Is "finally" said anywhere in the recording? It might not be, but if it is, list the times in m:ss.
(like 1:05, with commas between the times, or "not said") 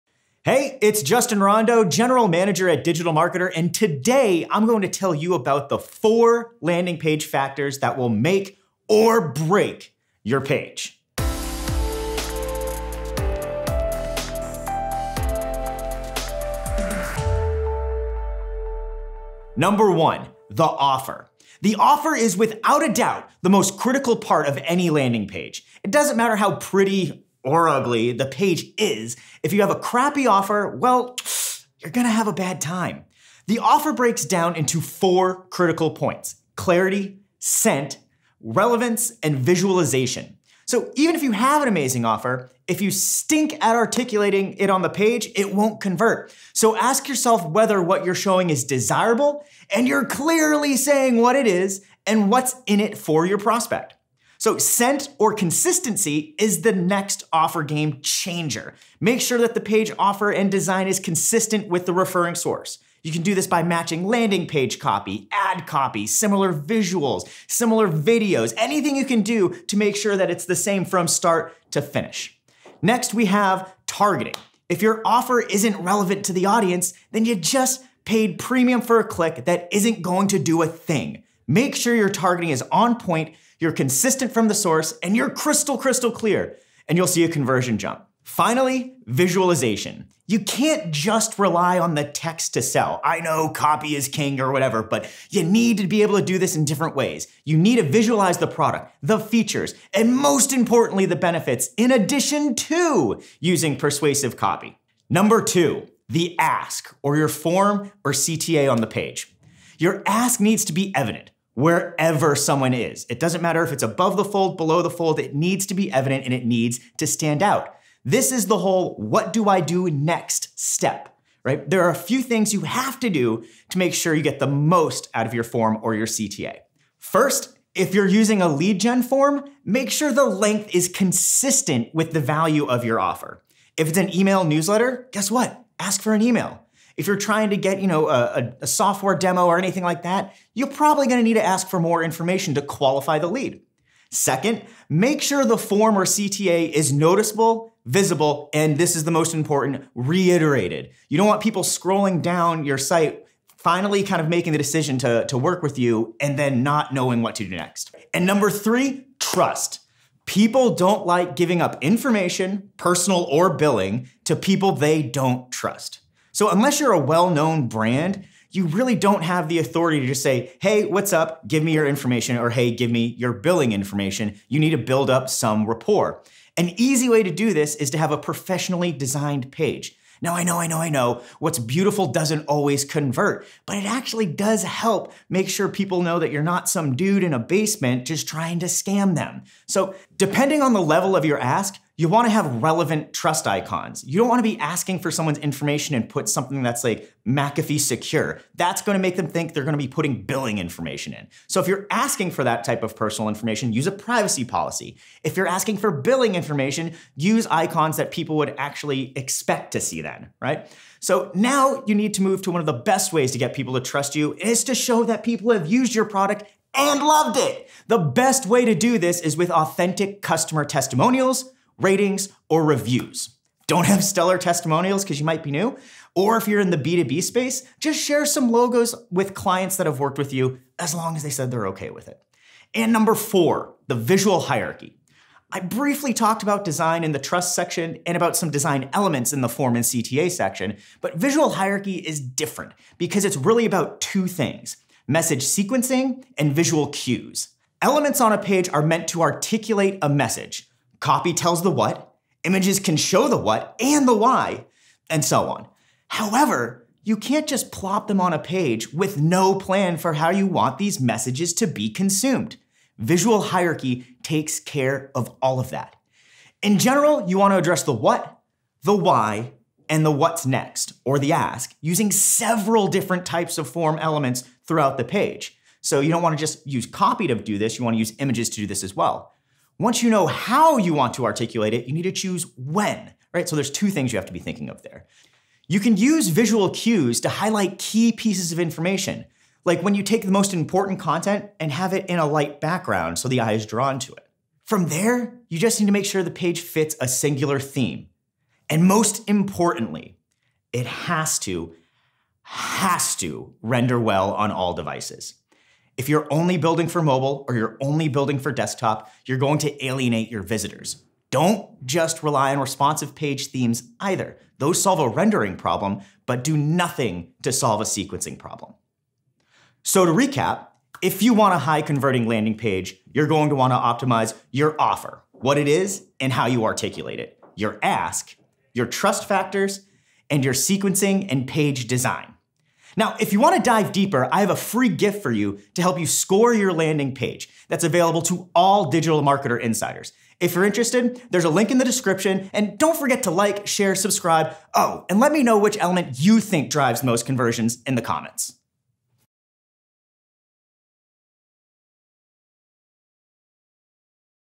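1:28, 2:33.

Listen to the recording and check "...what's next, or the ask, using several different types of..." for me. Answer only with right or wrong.
right.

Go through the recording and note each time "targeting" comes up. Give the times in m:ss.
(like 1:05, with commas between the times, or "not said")
1:13, 1:22.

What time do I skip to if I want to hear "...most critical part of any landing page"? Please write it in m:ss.
0:23.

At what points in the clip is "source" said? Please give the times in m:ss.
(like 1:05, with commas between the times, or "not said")
1:02, 1:24.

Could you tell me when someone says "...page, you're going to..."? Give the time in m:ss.
5:22.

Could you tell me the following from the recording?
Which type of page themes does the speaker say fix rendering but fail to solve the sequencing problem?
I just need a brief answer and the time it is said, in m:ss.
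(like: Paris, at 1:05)
Responsive page themes, at 5:12.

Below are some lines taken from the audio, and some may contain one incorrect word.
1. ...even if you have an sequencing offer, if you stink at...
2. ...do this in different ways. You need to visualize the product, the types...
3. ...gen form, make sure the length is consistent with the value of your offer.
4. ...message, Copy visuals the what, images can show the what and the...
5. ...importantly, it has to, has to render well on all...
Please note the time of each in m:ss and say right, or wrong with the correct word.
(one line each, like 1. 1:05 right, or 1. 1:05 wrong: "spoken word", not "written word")
1. 0:40 wrong: "amazing", not "sequencing"
2. 1:36 wrong: "features", not "types"
3. 2:08 right
4. 4:10 wrong: "tells", not "visuals"
5. 4:59 right.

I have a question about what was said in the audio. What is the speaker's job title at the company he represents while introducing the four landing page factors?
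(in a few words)
General Manager.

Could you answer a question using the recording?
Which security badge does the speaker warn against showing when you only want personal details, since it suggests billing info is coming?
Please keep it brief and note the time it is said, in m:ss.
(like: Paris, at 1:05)
McAfee secure, at 3:17.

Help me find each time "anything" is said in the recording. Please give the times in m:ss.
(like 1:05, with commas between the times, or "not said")
1:08, 2:19.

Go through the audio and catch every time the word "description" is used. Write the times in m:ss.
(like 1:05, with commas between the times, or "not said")
5:41.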